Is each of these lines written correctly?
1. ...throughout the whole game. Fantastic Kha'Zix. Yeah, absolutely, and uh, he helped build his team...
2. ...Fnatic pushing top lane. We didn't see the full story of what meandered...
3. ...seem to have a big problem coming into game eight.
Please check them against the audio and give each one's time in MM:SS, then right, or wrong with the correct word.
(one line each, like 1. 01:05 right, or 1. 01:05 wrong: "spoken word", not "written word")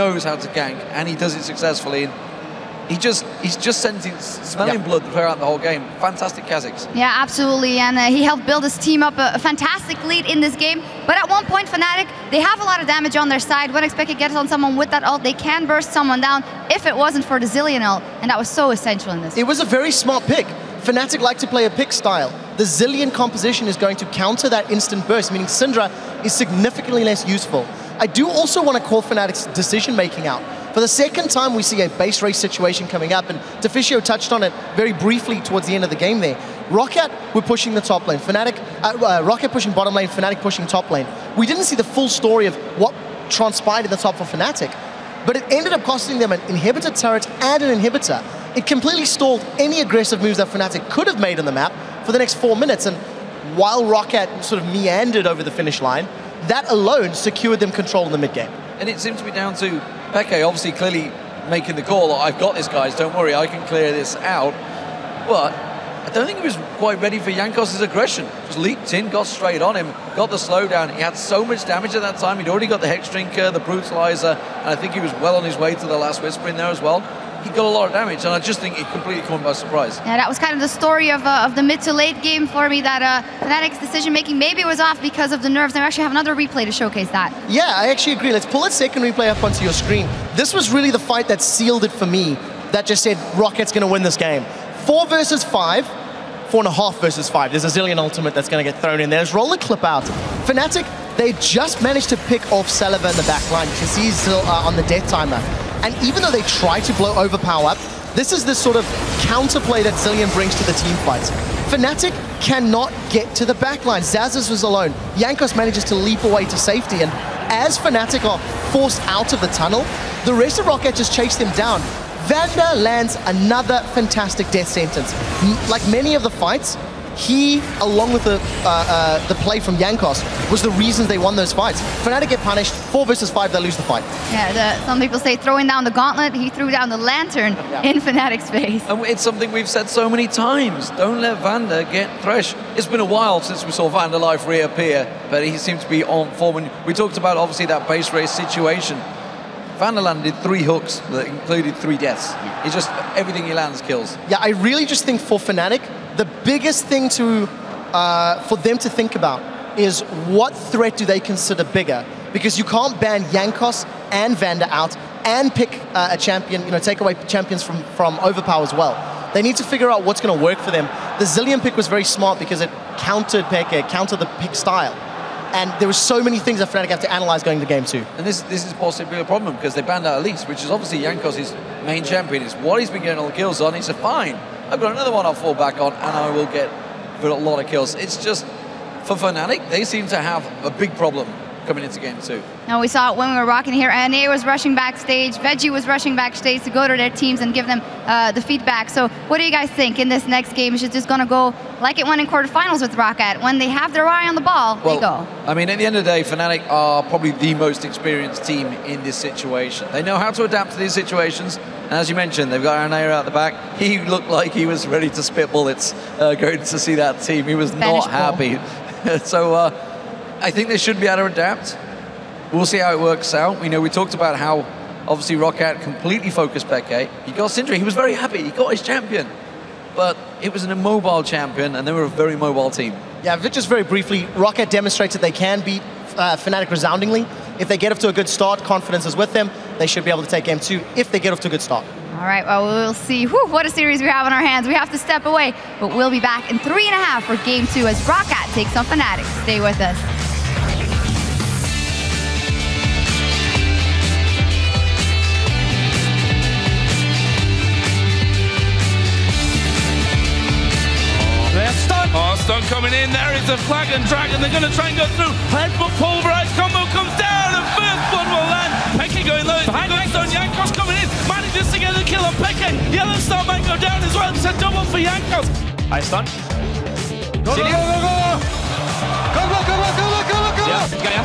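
1. 00:05 right
2. 00:40 wrong: "transpired", not "meandered"
3. 03:09 wrong: "two", not "eight".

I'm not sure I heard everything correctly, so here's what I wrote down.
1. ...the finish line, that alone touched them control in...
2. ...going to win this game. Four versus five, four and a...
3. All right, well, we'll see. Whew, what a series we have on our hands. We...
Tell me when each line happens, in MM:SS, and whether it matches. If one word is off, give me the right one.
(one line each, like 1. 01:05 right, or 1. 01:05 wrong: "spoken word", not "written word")
1. 00:55 wrong: "secured", not "touched"
2. 01:33 right
3. 04:02 right.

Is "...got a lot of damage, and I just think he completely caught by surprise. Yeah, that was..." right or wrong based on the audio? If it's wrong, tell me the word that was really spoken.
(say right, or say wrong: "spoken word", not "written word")
right.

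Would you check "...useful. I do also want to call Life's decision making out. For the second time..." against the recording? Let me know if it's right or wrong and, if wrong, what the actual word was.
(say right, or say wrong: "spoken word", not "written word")
wrong: "Fnatic", not "Life".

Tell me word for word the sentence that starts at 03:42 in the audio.
We'll see how it works out.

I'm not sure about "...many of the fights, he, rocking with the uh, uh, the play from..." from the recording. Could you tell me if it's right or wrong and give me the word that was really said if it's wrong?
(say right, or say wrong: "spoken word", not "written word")
wrong: "along", not "rocking".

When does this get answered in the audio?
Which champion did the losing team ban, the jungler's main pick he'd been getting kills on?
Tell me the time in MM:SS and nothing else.
03:00.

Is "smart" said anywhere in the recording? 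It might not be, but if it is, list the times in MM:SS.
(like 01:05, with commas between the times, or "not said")
00:19, 02:52.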